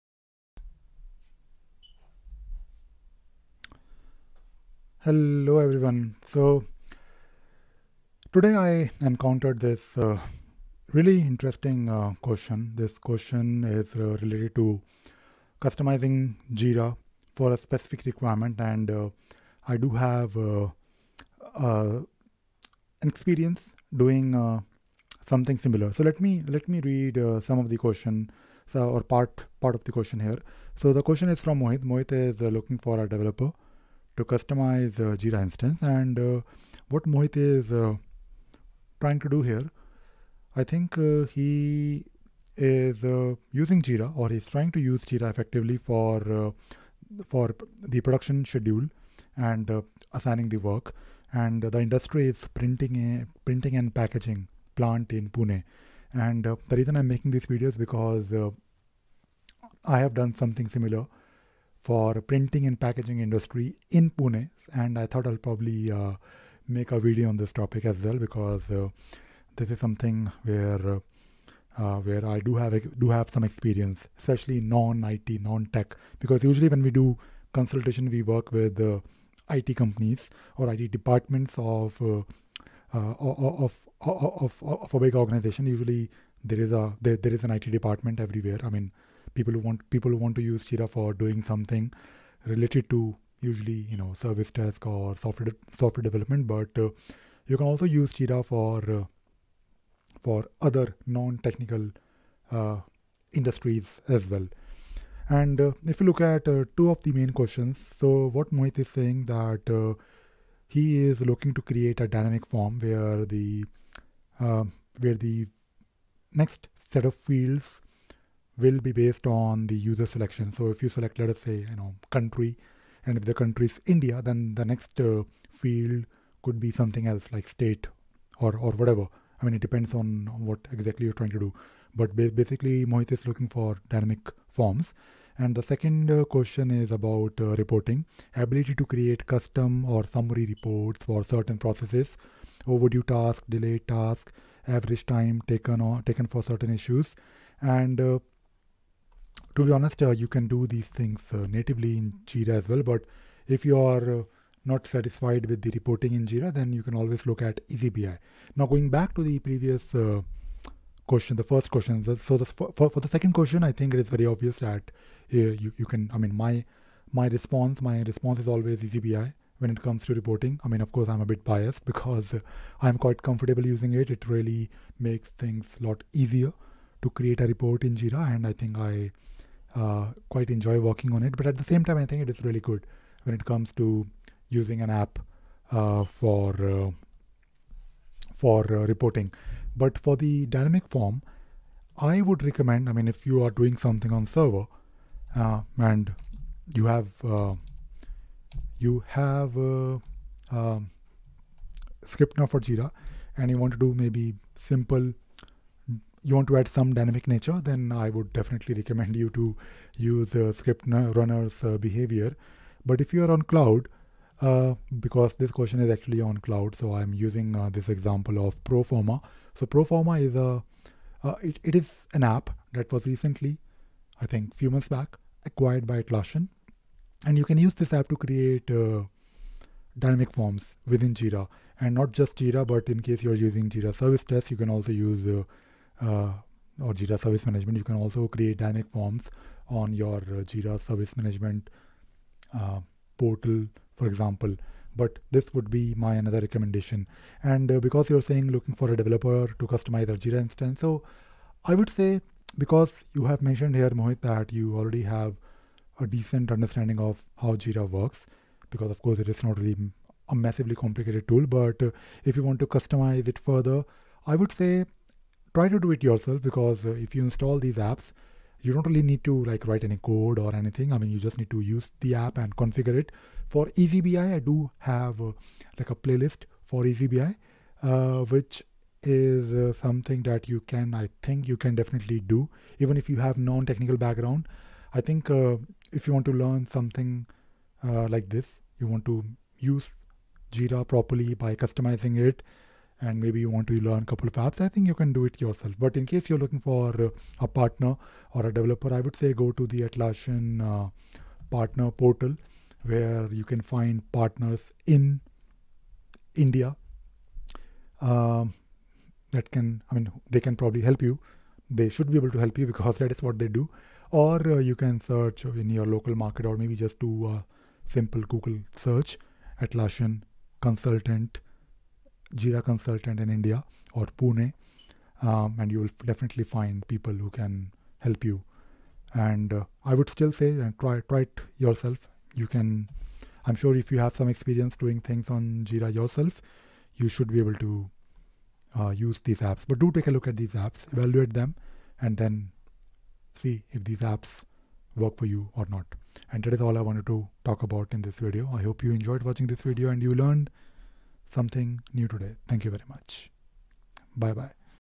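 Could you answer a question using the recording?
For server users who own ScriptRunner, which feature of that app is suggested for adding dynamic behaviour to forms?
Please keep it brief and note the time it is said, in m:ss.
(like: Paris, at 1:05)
Behavior, at 3:31.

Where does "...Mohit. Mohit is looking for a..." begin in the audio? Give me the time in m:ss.
0:31.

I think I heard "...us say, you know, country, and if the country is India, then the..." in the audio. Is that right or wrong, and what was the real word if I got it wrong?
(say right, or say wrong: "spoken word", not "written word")
right.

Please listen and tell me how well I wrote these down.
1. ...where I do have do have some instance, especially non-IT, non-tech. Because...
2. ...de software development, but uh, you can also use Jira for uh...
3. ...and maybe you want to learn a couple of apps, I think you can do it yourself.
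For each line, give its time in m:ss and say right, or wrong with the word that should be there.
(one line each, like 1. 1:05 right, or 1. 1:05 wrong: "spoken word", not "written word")
1. 1:12 wrong: "experience", not "instance"
2. 1:35 right
3. 4:53 right.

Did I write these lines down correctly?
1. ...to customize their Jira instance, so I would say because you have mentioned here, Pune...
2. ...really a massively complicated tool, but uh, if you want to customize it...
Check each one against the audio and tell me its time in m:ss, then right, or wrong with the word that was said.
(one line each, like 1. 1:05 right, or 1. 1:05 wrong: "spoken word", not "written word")
1. 4:09 wrong: "Mohit", not "Pune"
2. 4:19 right.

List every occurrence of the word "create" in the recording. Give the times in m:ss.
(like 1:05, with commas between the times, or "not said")
1:51, 2:18, 2:57, 3:48, 3:58.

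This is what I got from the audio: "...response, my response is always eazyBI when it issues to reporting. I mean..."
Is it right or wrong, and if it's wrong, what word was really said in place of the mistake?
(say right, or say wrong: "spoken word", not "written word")
wrong: "comes", not "issues".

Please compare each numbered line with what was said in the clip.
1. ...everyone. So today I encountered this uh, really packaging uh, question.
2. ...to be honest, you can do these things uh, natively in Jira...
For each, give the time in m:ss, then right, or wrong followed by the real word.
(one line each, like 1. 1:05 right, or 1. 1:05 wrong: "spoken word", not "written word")
1. 0:05 wrong: "interesting", not "packaging"
2. 2:29 right.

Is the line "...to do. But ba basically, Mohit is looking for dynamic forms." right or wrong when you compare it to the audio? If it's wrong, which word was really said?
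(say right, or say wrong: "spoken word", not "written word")
right.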